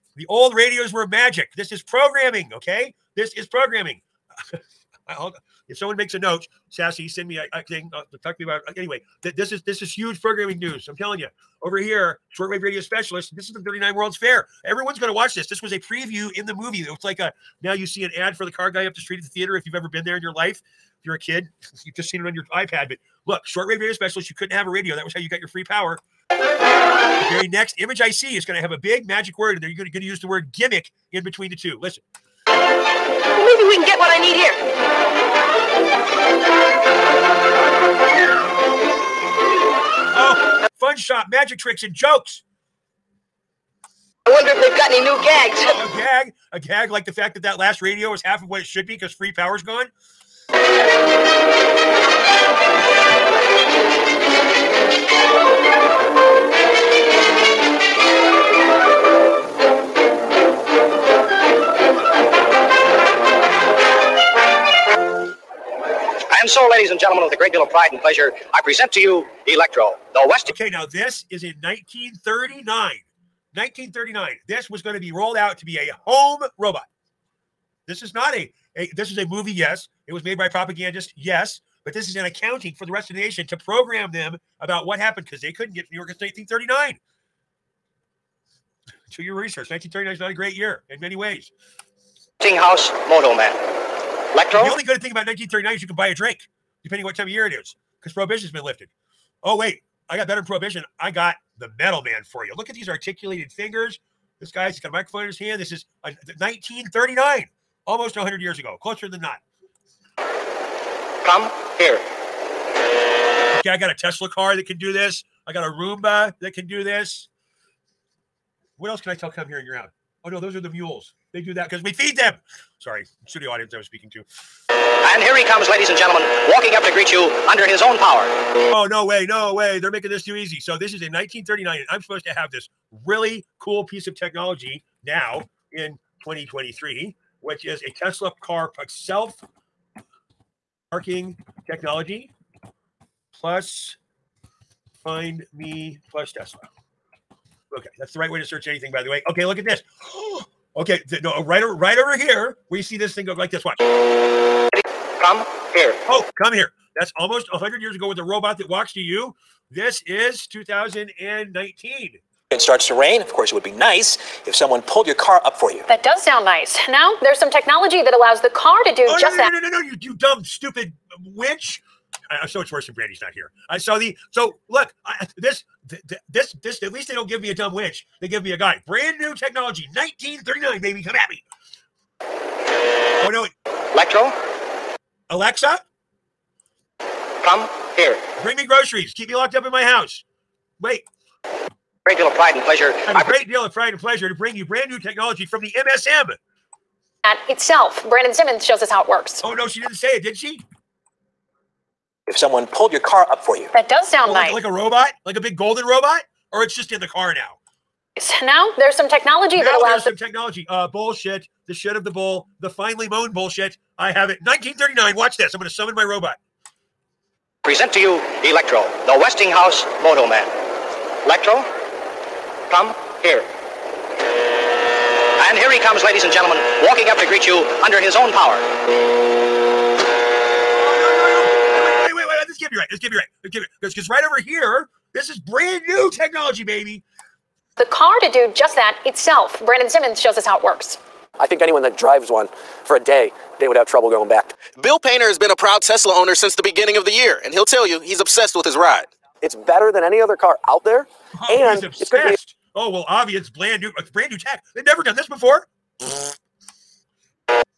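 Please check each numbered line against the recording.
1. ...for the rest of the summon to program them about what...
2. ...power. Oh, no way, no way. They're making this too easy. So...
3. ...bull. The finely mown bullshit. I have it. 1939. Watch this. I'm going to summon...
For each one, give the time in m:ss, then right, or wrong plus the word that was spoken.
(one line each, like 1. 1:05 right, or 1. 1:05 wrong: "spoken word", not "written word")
1. 1:22 wrong: "nation", not "summon"
2. 2:07 right
3. 3:32 right.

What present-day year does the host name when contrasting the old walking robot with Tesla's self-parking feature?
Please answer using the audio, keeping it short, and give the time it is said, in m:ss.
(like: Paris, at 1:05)
2023, at 2:16.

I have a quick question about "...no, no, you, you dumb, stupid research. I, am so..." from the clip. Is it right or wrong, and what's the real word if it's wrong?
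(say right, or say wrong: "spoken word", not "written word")
wrong: "witch", not "research".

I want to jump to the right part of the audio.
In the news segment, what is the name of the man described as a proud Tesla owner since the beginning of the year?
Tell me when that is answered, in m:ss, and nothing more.
4:04.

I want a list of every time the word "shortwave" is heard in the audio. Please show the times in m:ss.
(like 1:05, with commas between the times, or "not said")
0:12, 0:23.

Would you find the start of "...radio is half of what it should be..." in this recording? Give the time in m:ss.
0:47.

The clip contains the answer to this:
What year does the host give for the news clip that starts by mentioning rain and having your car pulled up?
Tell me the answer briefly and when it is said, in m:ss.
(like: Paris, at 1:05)
2019, at 2:40.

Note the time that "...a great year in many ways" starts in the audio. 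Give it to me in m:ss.
1:30.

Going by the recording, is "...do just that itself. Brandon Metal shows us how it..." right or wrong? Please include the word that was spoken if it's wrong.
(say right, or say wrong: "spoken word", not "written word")
wrong: "Simmons", not "Metal".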